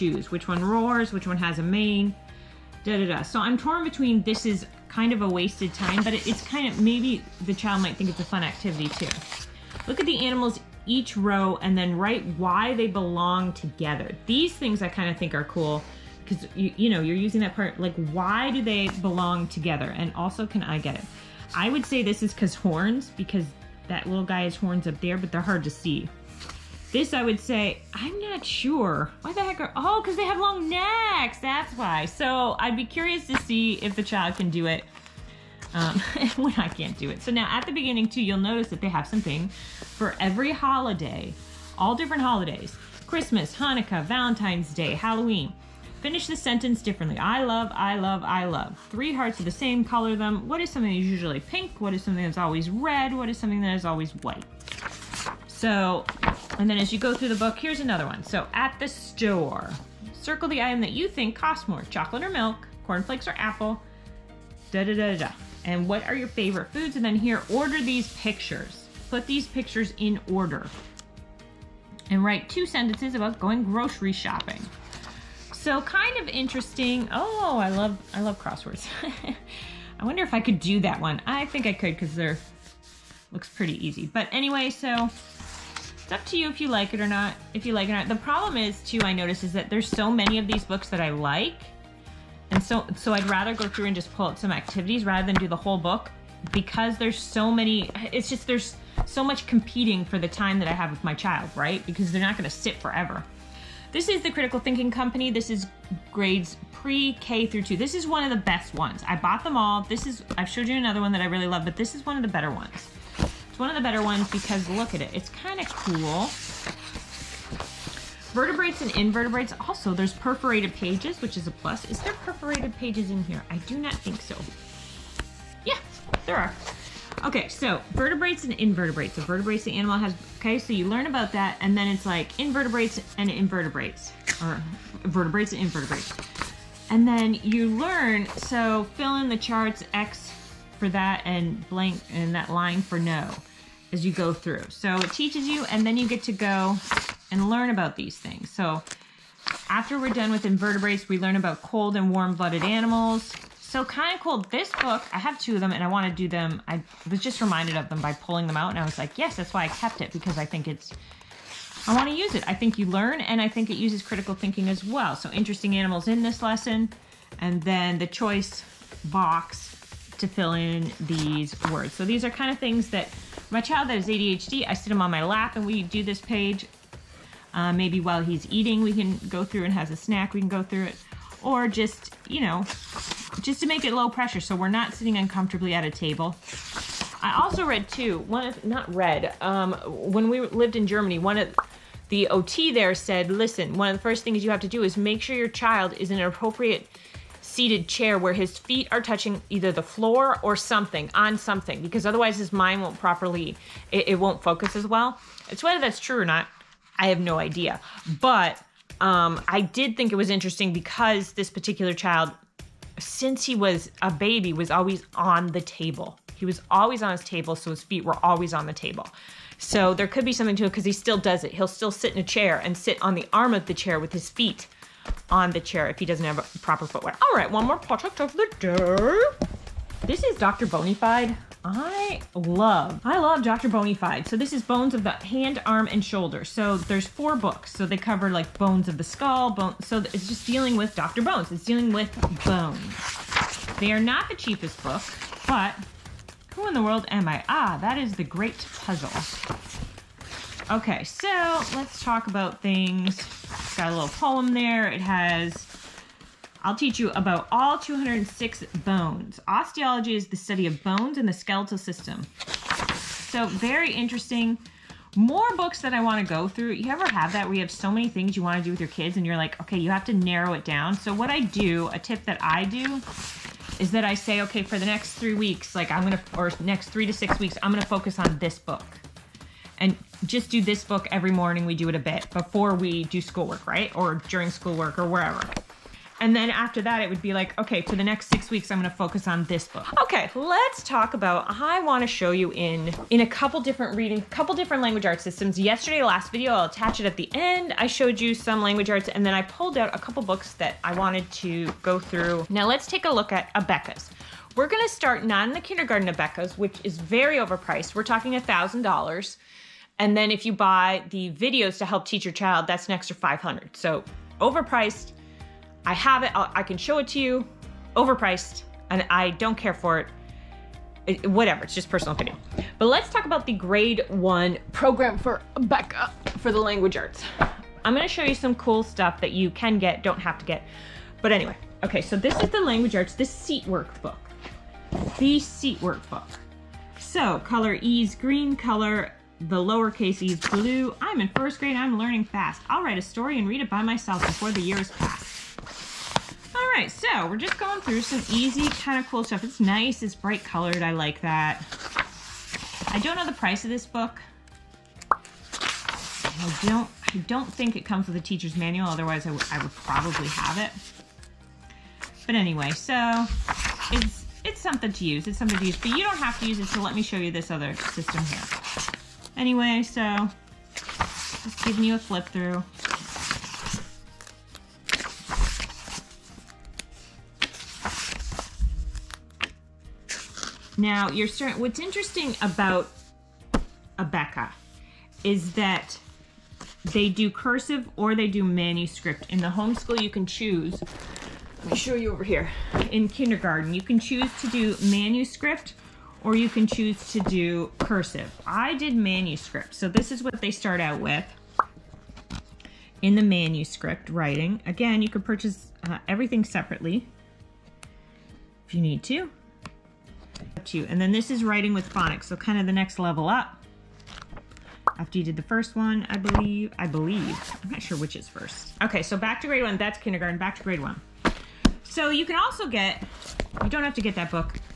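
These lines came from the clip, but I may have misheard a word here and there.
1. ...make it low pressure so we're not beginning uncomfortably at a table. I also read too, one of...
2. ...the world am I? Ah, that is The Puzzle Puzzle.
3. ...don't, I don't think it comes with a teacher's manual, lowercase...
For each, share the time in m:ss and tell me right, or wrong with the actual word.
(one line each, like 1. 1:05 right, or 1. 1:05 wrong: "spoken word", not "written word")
1. 3:03 wrong: "sitting", not "beginning"
2. 4:06 wrong: "Great", not "Puzzle"
3. 5:56 wrong: "otherwise", not "lowercase".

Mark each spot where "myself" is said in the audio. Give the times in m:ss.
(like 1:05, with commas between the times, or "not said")
5:43.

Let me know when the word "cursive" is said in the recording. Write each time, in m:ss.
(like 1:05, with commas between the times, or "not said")
6:27, 6:37.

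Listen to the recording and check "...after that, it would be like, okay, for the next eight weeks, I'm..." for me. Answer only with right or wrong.
wrong.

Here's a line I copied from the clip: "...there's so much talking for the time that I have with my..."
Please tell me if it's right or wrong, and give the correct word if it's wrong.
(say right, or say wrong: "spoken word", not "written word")
wrong: "competing", not "talking".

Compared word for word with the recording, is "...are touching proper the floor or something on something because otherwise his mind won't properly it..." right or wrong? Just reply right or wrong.
wrong.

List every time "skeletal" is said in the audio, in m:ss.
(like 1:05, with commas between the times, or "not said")
4:21.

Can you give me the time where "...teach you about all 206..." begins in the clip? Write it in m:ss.
4:16.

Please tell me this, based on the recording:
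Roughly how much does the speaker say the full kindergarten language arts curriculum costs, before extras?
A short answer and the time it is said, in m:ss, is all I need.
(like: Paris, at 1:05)
$1,000, at 5:08.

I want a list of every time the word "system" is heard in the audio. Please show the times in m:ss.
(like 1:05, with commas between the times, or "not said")
4:21, 4:55, 6:07.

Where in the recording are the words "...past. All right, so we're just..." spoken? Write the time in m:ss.
5:44.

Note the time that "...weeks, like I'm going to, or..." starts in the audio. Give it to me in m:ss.
4:35.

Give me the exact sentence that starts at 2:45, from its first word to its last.
So interesting animals in this lesson, and then the choice box to fill in these words.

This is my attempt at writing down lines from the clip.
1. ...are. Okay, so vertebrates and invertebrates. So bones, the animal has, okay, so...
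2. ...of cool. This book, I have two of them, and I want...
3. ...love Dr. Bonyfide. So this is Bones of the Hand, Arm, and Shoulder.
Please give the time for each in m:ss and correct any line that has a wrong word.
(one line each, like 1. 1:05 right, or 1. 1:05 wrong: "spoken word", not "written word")
1. 2:06 wrong: "vertebrates", not "bones"
2. 2:34 right
3. 3:53 right.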